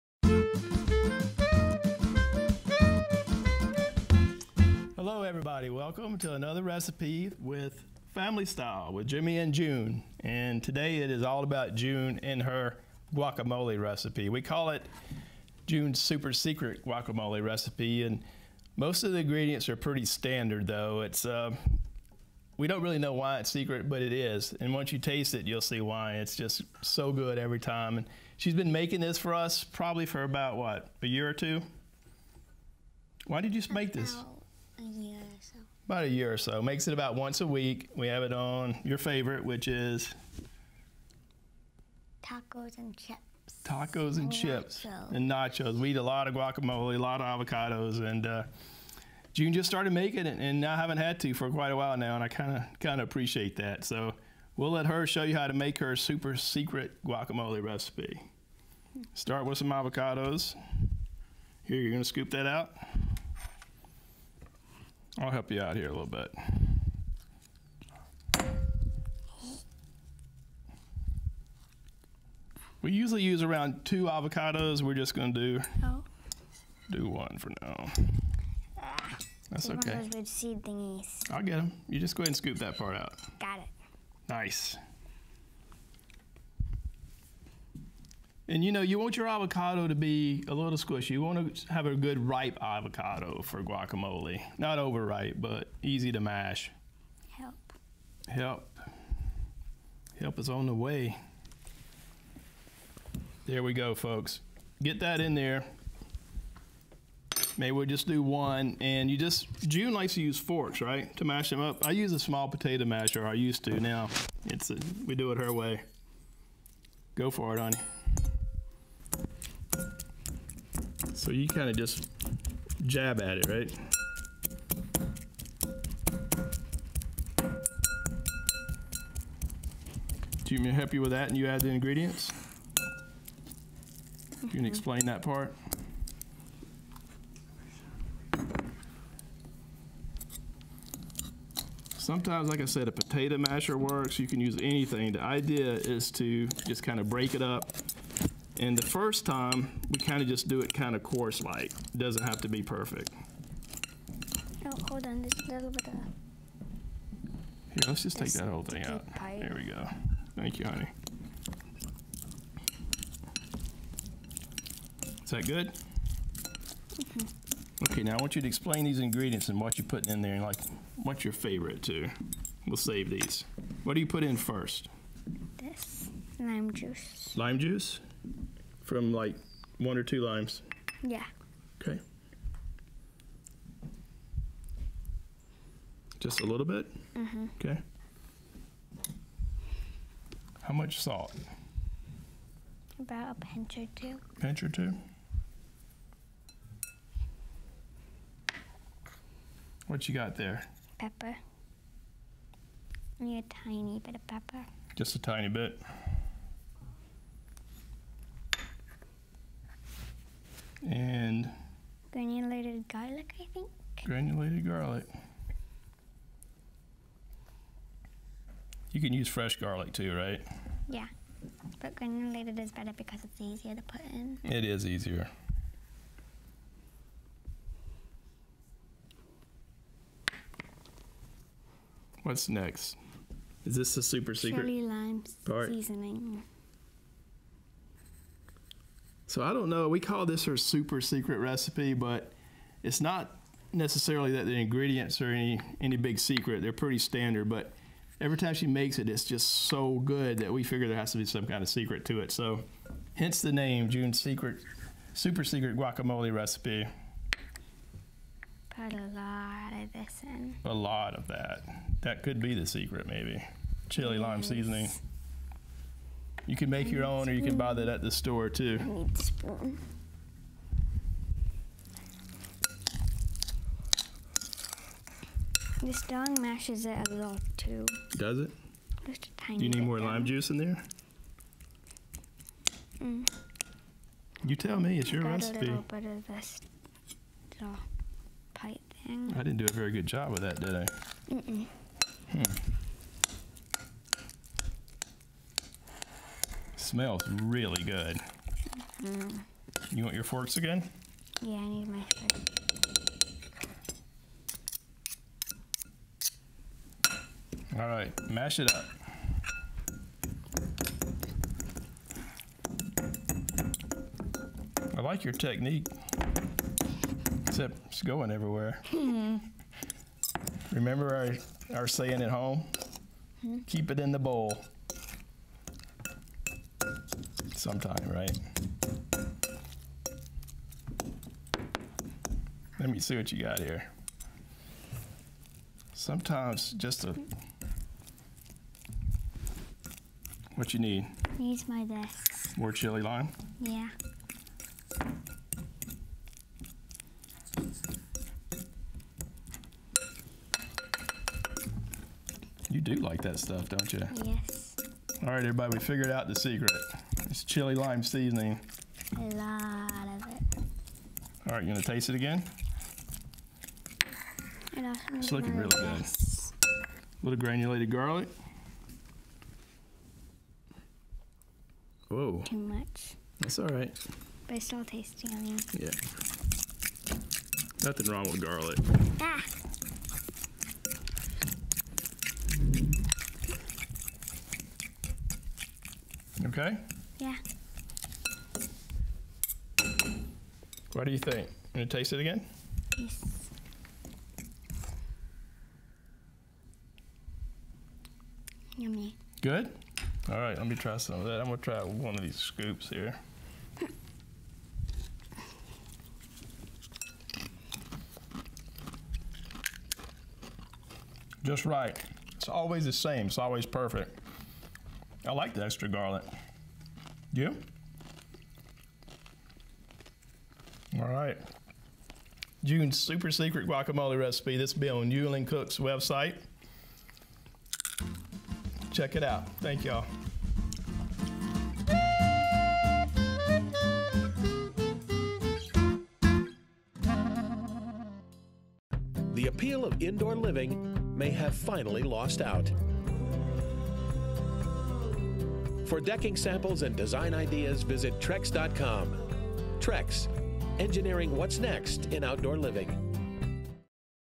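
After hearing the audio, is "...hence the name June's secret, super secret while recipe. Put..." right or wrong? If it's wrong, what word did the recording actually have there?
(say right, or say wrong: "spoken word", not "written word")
wrong: "guacamole", not "while".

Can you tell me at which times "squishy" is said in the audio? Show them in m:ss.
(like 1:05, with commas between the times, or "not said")
1:30.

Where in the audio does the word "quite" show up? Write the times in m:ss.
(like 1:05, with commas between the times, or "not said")
0:51.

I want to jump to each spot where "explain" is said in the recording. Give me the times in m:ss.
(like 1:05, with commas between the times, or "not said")
2:14, 2:48.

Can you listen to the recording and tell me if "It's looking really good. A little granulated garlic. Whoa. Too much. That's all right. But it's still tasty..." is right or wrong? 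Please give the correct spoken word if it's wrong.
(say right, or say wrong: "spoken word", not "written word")
right.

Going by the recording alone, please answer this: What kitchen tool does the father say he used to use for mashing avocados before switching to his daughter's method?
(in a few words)
Small potato masher.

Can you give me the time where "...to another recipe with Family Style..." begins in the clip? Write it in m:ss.
0:06.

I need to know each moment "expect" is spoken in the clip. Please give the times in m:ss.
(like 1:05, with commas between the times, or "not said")
not said.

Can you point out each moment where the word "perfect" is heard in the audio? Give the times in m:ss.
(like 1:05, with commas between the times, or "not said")
2:32, 6:53.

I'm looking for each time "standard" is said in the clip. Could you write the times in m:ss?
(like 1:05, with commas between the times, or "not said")
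0:20, 4:06.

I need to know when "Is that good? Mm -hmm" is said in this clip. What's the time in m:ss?
2:45.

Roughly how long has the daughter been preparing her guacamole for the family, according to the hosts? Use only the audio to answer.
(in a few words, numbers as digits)
About a year.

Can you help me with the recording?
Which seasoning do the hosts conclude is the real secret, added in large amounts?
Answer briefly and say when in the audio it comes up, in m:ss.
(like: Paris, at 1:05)
Chili lime seasoning, at 5:57.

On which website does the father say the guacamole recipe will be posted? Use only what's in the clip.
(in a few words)
New England Cooks.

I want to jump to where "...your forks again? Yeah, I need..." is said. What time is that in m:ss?
5:00.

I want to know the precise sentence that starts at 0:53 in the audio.
So we'll let her show you how to make her super secret guacamole recipe.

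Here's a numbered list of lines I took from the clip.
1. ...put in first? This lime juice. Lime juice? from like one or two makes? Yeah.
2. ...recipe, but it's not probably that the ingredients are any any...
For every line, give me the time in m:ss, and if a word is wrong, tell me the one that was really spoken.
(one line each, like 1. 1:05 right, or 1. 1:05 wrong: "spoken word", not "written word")
1. 2:54 wrong: "limes", not "makes"
2. 4:01 wrong: "necessarily", not "probably".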